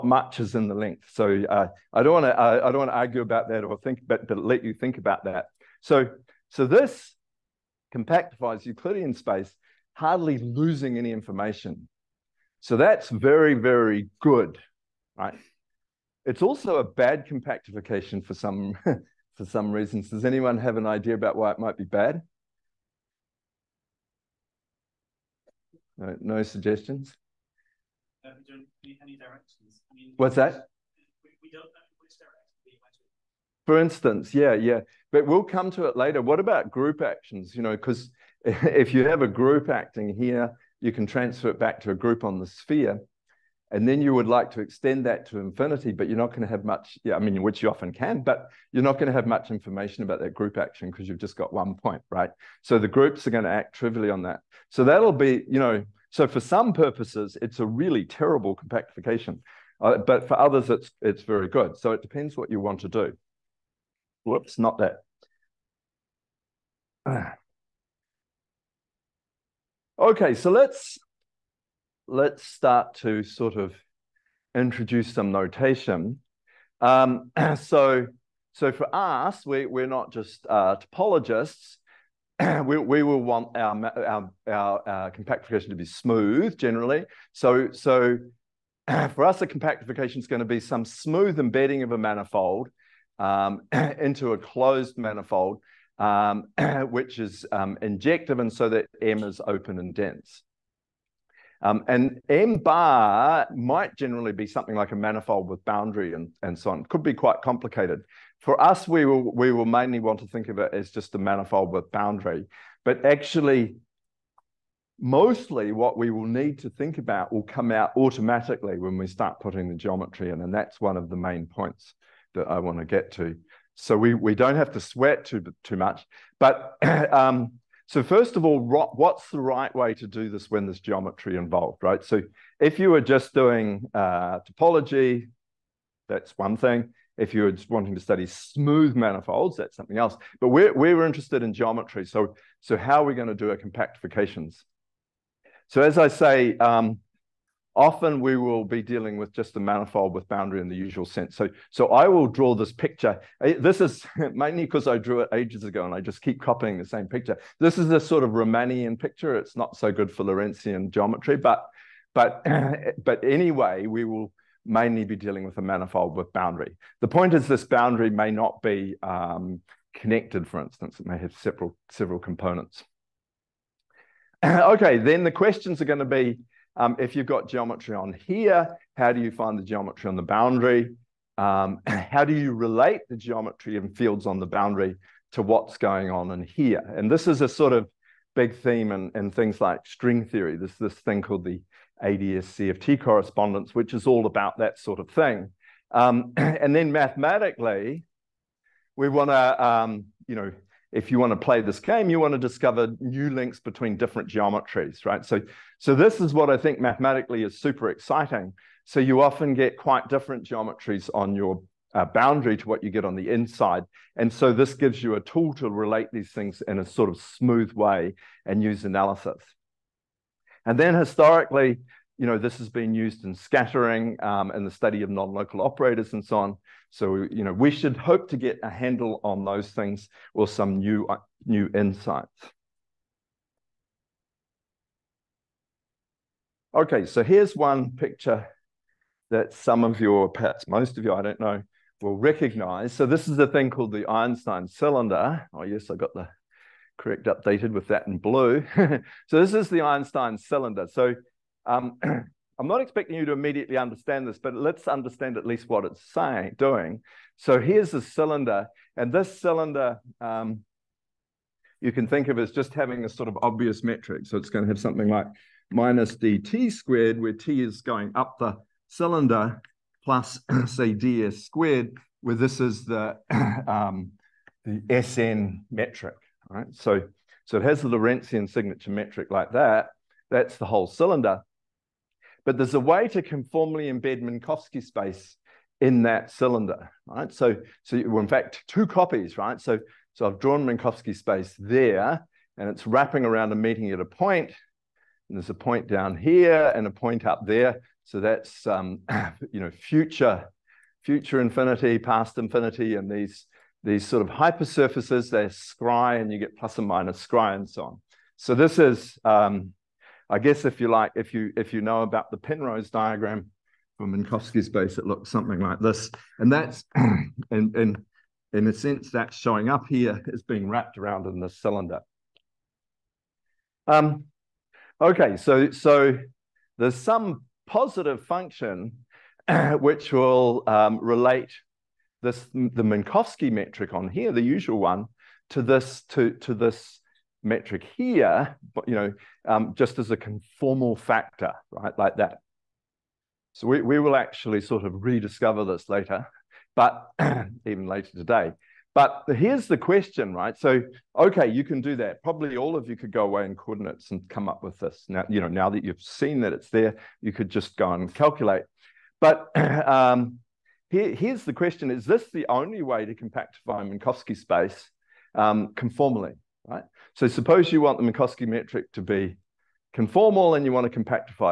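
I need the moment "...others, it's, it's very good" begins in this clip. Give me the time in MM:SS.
01:00.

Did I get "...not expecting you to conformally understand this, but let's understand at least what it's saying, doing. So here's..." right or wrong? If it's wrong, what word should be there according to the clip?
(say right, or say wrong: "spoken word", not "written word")
wrong: "immediately", not "conformally".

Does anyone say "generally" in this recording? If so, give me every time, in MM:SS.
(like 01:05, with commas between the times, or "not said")
01:26, 01:43.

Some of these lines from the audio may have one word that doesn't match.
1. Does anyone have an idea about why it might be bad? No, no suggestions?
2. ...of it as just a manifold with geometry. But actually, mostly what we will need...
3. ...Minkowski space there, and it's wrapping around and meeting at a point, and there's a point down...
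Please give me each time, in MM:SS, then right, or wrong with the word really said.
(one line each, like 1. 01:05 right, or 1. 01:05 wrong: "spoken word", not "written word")
1. 00:20 right
2. 01:50 wrong: "boundary", not "geometry"
3. 04:50 right.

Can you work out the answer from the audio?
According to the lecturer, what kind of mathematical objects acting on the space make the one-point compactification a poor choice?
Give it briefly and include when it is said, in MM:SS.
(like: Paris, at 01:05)
Group actions, at 00:36.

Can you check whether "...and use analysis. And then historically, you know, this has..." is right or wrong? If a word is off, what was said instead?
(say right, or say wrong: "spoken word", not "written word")
right.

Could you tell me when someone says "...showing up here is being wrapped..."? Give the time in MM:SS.
05:19.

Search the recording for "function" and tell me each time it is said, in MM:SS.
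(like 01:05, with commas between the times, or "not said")
05:28.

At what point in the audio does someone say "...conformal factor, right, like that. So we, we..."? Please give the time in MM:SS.
05:40.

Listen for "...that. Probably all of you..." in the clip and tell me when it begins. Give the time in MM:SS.
05:51.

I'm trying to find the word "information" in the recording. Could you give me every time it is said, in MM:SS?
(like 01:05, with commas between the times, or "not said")
00:11, 00:49.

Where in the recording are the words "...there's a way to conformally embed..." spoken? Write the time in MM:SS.
04:42.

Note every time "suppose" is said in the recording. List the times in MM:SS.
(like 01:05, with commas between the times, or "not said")
06:07.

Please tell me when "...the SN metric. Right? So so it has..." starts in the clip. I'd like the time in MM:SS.
04:34.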